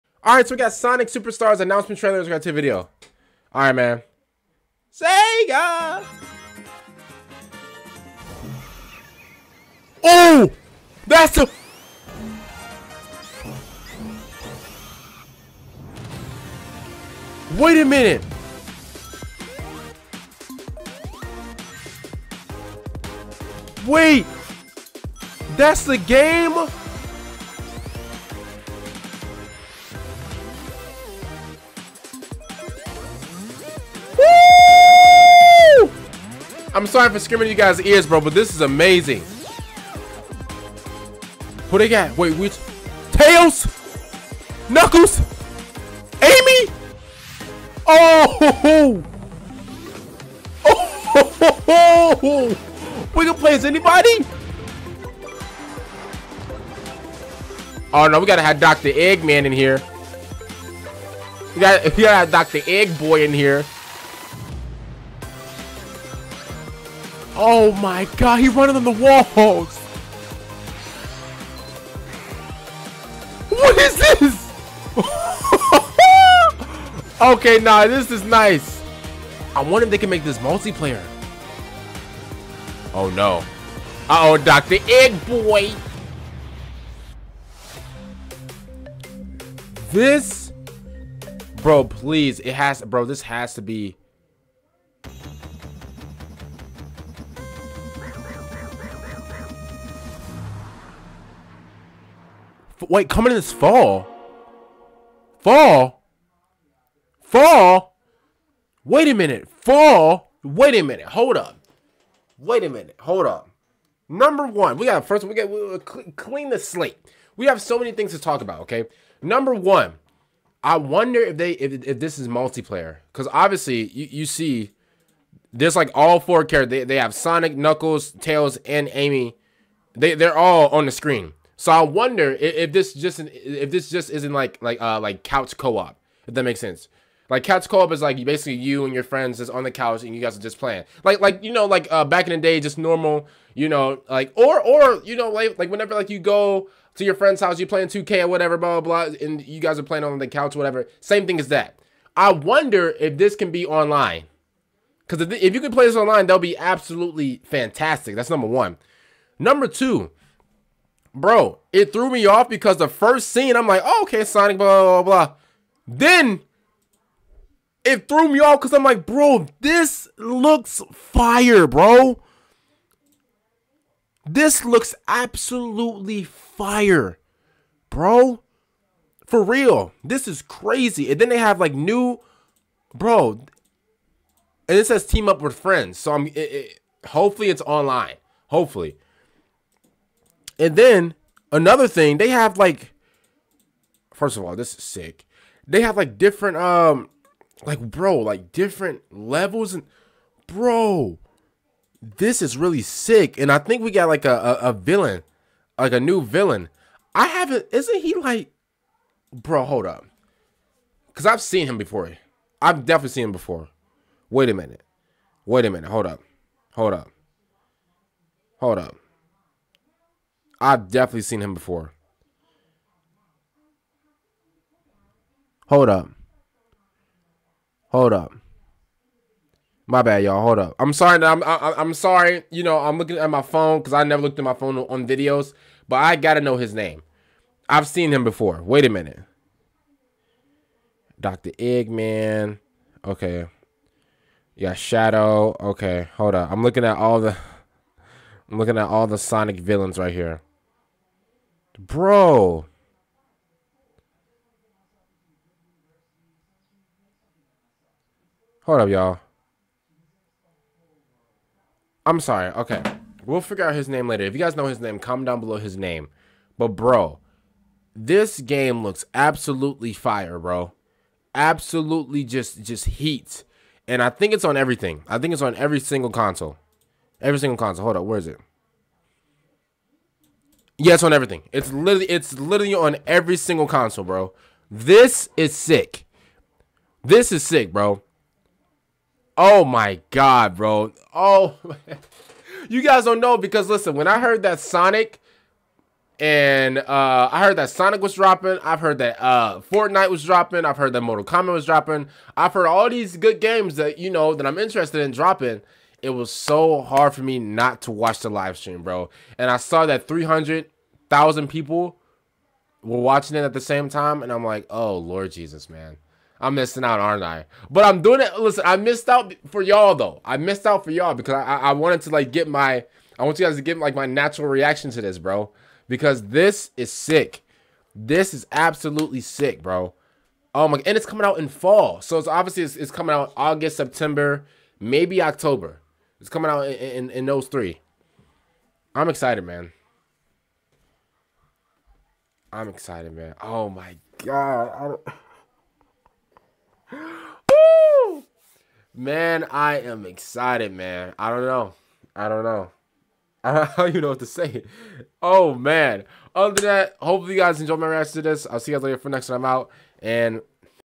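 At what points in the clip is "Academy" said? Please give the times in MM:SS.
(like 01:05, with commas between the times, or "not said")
not said.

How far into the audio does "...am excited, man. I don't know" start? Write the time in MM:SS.
05:49.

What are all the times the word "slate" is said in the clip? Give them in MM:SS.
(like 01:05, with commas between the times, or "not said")
01:56.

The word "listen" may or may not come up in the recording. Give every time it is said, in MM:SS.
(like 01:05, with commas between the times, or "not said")
04:53, 05:18.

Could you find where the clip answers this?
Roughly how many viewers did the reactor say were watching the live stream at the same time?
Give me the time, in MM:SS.
05:10.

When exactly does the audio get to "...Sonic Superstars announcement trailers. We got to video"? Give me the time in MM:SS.
00:00.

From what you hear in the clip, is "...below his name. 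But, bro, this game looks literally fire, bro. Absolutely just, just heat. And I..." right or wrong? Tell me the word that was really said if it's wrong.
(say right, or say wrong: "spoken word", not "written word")
wrong: "absolutely", not "literally".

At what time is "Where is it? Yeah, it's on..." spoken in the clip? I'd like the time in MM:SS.
04:38.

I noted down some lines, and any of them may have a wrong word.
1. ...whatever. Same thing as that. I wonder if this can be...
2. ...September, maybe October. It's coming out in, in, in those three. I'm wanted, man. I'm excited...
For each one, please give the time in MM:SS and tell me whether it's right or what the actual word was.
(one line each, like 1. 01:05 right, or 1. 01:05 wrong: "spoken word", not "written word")
1. 02:30 right
2. 05:33 wrong: "excited", not "wanted".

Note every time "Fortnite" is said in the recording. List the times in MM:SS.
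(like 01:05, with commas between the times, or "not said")
04:59.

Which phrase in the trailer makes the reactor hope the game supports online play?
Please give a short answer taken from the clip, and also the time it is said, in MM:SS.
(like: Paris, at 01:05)
team up with friends, at 03:05.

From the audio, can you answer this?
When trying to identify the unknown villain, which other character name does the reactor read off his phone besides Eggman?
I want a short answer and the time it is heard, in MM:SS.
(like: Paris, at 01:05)
Shadow, at 04:04.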